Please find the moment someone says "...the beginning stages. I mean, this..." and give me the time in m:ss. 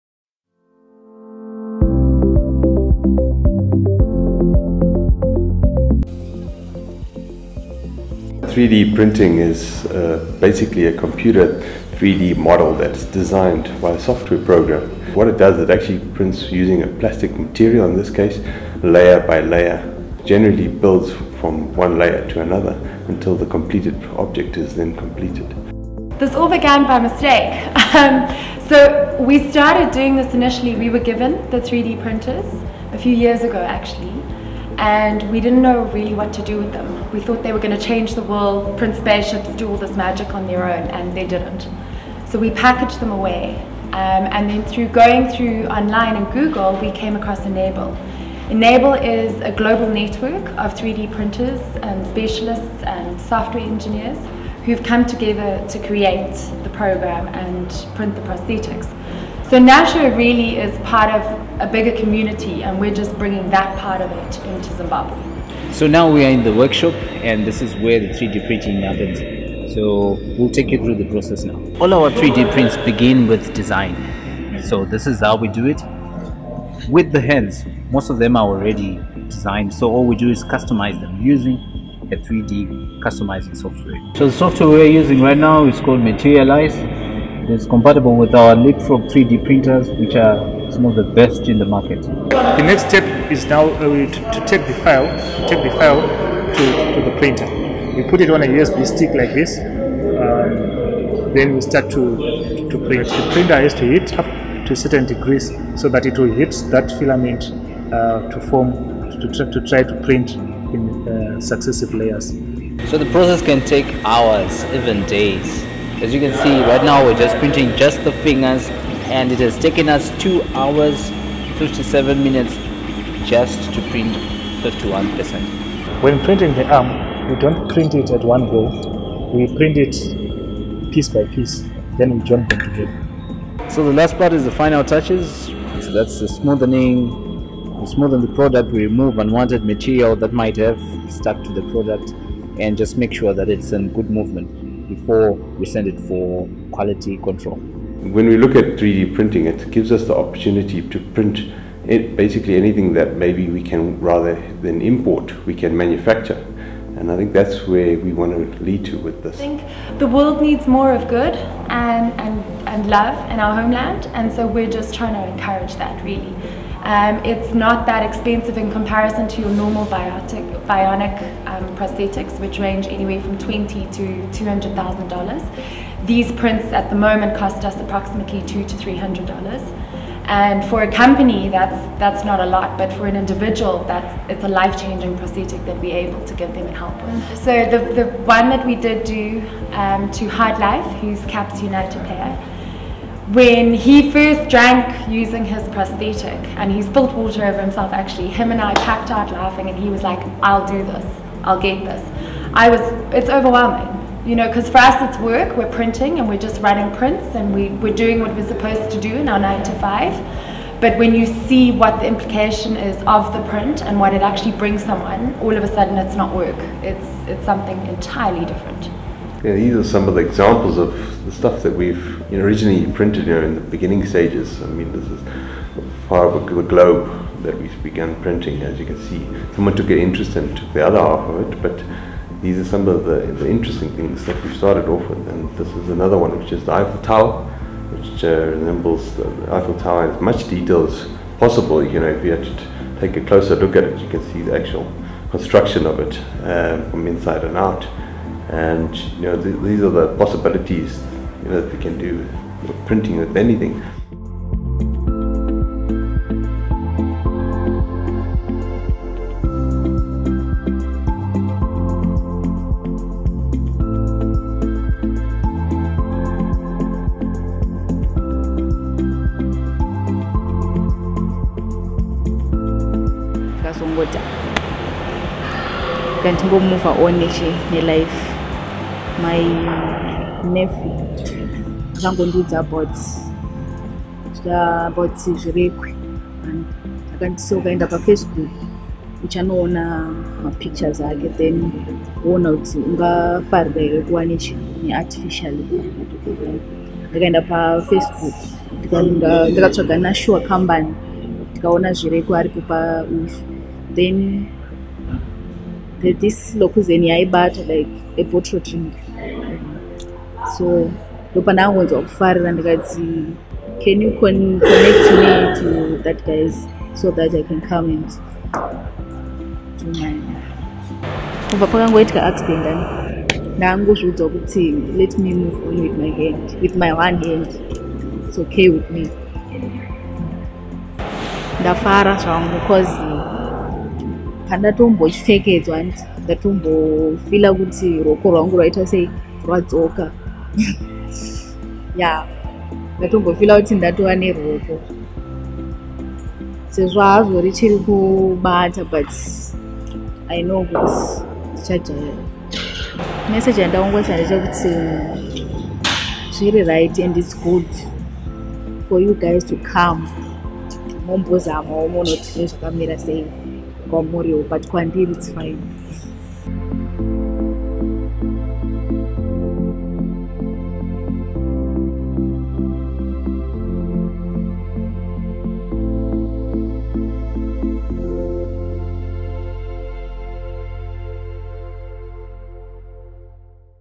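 3:43.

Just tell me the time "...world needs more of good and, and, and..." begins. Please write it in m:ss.
2:40.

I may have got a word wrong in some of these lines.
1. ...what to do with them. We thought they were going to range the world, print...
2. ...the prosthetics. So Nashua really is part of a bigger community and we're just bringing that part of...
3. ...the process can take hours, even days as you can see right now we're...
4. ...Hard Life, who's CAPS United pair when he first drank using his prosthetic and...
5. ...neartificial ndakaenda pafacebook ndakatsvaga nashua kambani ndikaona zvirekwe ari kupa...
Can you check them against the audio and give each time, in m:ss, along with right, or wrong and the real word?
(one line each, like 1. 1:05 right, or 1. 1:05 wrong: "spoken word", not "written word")
1. 0:36 wrong: "change", not "range"
2. 0:58 right
3. 1:52 right
4. 3:10 right
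5. 4:54 right.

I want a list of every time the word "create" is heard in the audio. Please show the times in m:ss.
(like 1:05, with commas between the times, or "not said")
0:55.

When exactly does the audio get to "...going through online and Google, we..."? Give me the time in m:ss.
0:44.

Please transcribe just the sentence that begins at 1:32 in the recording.
The next step is now uh, to, to, take the file, take the file to, to the printer.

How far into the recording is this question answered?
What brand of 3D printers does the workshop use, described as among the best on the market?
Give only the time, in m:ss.
1:28.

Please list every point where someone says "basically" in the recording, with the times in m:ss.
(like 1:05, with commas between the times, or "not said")
0:10, 2:32.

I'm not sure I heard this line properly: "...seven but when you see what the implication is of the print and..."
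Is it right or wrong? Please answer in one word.
wrong.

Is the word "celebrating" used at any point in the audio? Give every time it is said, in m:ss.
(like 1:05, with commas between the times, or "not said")
not said.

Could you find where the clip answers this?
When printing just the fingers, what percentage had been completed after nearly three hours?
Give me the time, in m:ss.
2:04.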